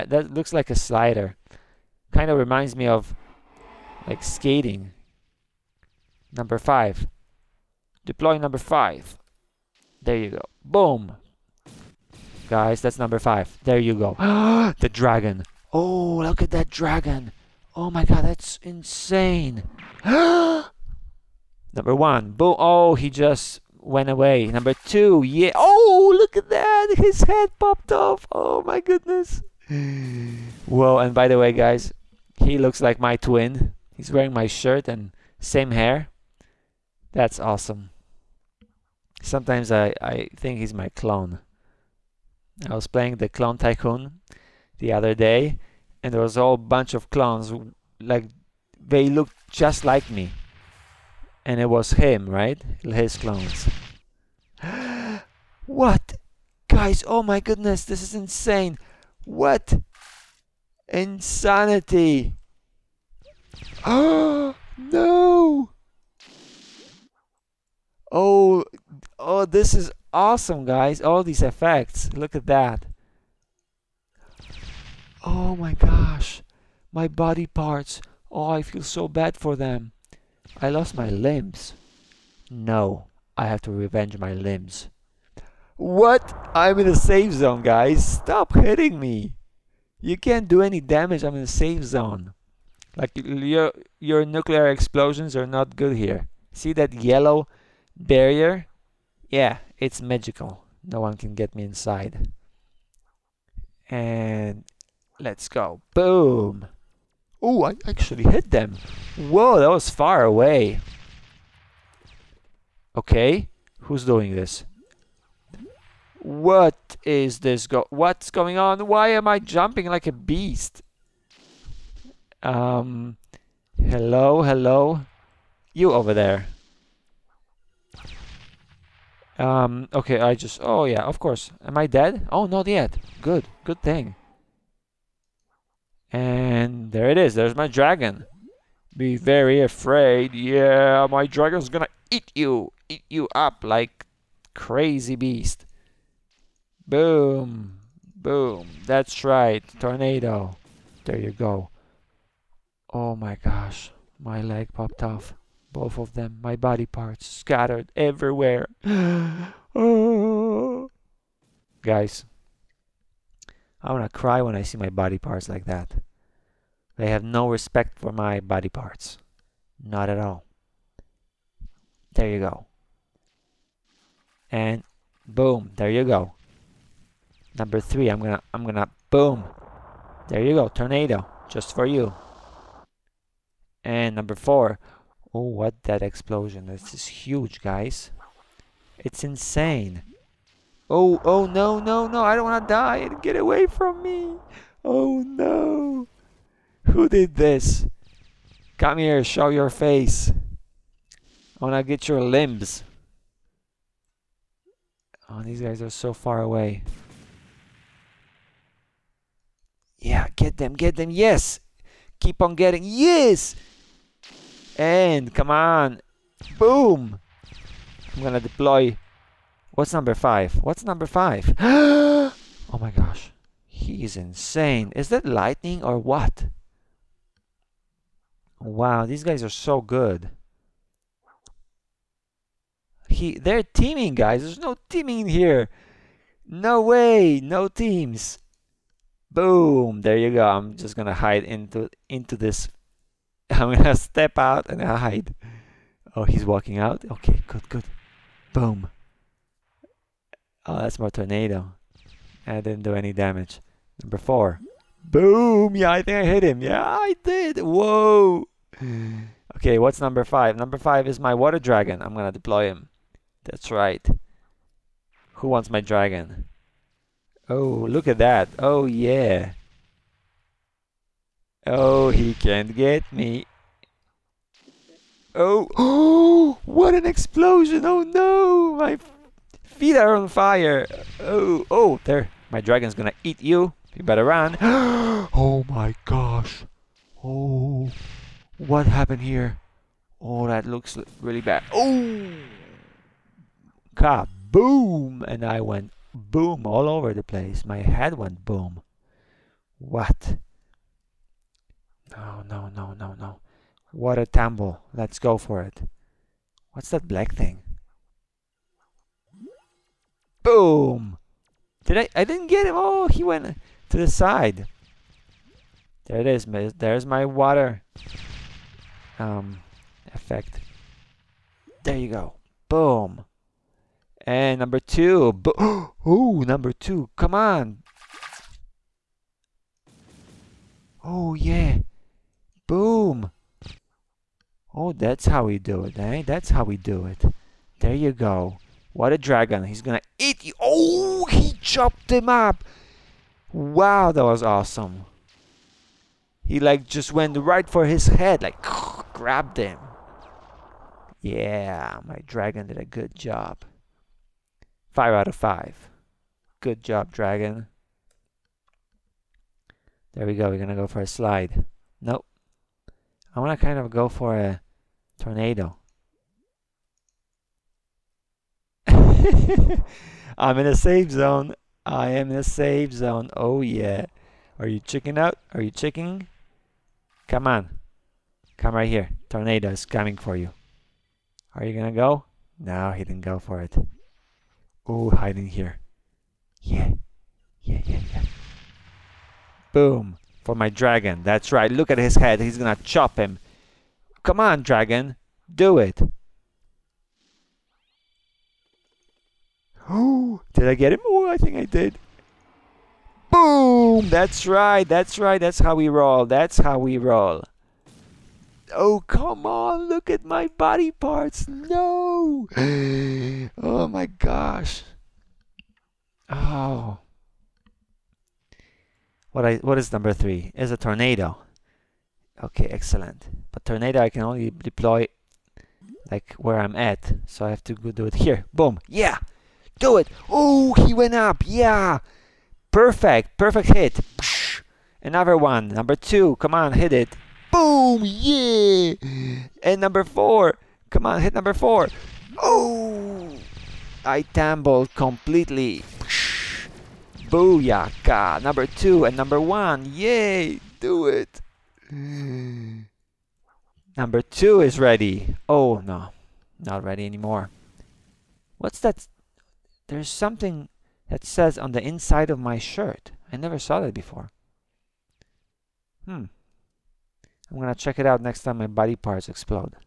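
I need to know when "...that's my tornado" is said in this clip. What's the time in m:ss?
4:10.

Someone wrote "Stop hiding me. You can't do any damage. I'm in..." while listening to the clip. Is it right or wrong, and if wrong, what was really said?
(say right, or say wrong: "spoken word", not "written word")
wrong: "hitting", not "hiding".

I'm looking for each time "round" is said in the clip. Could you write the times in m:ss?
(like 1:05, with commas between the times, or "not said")
not said.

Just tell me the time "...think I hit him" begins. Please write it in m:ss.
4:16.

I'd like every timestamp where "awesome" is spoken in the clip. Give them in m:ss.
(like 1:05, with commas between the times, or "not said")
0:37, 1:10, 5:44.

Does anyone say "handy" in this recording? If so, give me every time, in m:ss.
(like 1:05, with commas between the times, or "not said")
not said.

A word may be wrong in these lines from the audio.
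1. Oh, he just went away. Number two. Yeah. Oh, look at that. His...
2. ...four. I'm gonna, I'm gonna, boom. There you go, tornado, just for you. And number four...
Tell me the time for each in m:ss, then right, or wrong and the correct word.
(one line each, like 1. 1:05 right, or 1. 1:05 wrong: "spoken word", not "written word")
1. 0:22 right
2. 2:57 wrong: "three", not "four".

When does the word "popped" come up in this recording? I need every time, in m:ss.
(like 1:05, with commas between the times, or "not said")
0:27, 2:34.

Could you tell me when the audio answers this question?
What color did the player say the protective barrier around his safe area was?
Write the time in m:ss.
1:36.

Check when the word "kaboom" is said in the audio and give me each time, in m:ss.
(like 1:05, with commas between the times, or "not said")
4:53.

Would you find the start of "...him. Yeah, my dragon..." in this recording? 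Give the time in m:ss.
5:49.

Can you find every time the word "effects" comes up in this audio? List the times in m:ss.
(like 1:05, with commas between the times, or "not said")
1:11, 5:20.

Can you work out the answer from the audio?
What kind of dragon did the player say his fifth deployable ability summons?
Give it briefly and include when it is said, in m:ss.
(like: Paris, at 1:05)
Water dragon, at 4:21.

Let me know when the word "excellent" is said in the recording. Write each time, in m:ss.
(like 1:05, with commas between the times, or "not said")
7:02.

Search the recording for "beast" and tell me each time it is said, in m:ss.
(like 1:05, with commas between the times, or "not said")
2:00, 2:25.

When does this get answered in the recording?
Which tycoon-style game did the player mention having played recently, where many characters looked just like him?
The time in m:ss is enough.
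0:43.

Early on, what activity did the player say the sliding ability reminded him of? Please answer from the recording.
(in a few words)
Skating.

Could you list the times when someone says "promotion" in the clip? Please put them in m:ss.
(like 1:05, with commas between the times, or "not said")
not said.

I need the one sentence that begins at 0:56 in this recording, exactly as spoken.
Guys, oh my goodness, this is insane.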